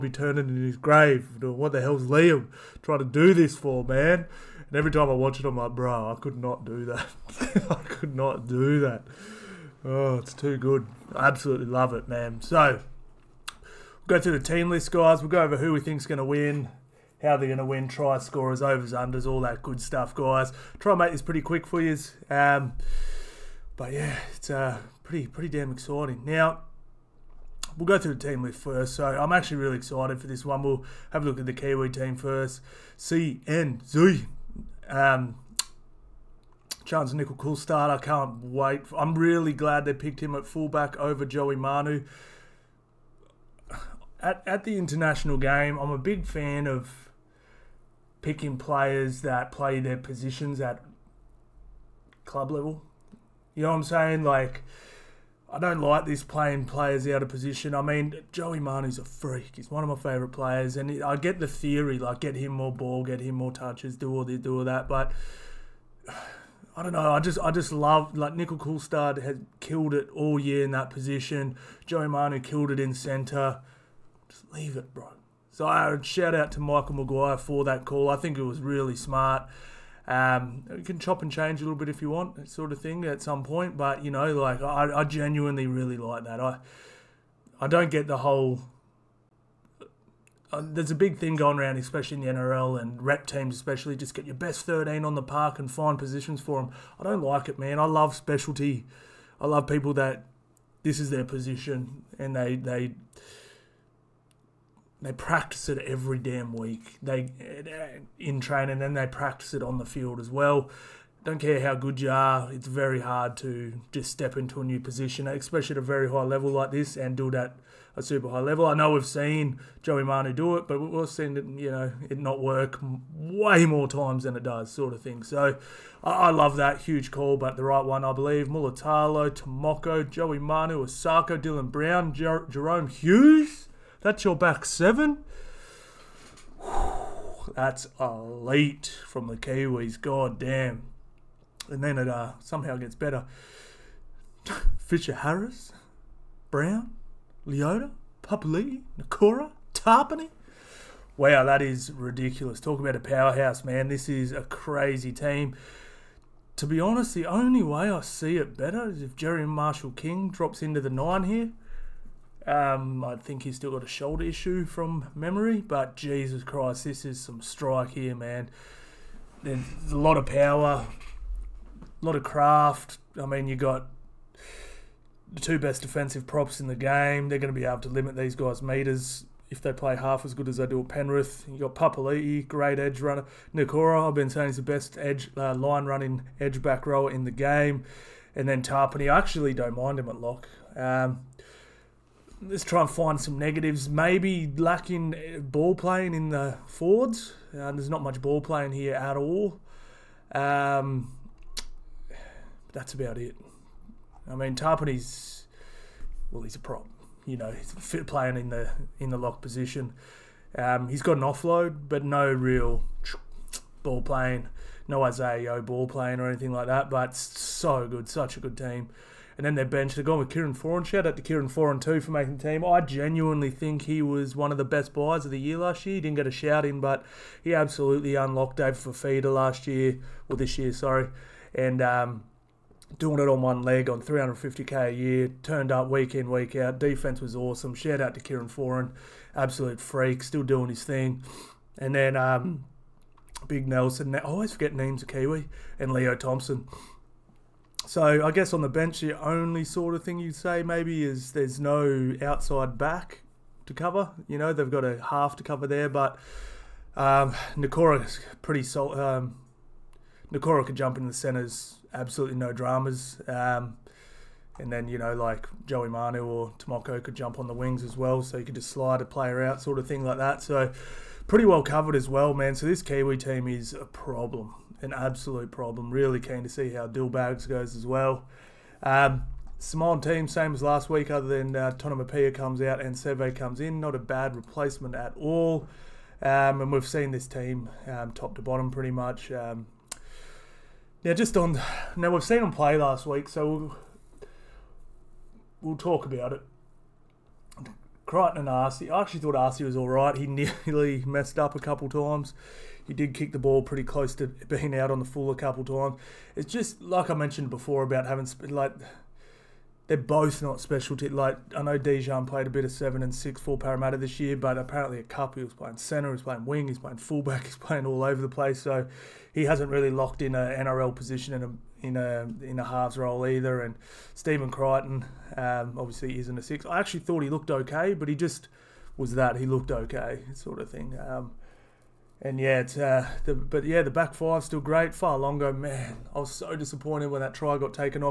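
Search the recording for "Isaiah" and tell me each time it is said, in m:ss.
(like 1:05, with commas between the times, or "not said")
3:35.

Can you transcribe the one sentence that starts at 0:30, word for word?
We'll have a look at the Kiwi team first.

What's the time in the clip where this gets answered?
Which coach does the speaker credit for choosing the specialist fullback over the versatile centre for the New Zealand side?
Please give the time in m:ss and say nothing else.
1:16.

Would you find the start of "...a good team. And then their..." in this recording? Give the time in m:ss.
3:38.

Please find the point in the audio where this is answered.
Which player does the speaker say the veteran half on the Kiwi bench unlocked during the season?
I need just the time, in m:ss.
3:48.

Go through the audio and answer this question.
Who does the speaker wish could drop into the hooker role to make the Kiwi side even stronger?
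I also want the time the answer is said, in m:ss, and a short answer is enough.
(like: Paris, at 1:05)
Jerry Marshall King, at 2:39.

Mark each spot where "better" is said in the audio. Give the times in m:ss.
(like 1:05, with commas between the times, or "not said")
2:22, 2:38.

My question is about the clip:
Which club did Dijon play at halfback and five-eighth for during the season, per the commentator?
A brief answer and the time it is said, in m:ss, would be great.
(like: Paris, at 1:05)
Parramatta, at 5:13.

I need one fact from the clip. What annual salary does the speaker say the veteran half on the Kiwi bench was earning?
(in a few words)
350k.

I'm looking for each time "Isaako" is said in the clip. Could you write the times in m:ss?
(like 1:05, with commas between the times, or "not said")
2:10.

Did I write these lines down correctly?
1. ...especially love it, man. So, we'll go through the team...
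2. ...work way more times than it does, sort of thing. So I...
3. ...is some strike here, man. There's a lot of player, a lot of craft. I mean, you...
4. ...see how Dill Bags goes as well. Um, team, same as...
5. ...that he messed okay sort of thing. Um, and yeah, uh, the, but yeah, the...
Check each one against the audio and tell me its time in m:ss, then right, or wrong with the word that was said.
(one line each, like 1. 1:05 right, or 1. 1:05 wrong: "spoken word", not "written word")
1. 0:11 wrong: "absolutely", not "especially"
2. 2:02 right
3. 2:47 wrong: "power", not "player"
4. 4:36 right
5. 5:29 wrong: "looked", not "messed".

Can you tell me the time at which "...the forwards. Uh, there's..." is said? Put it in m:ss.
3:16.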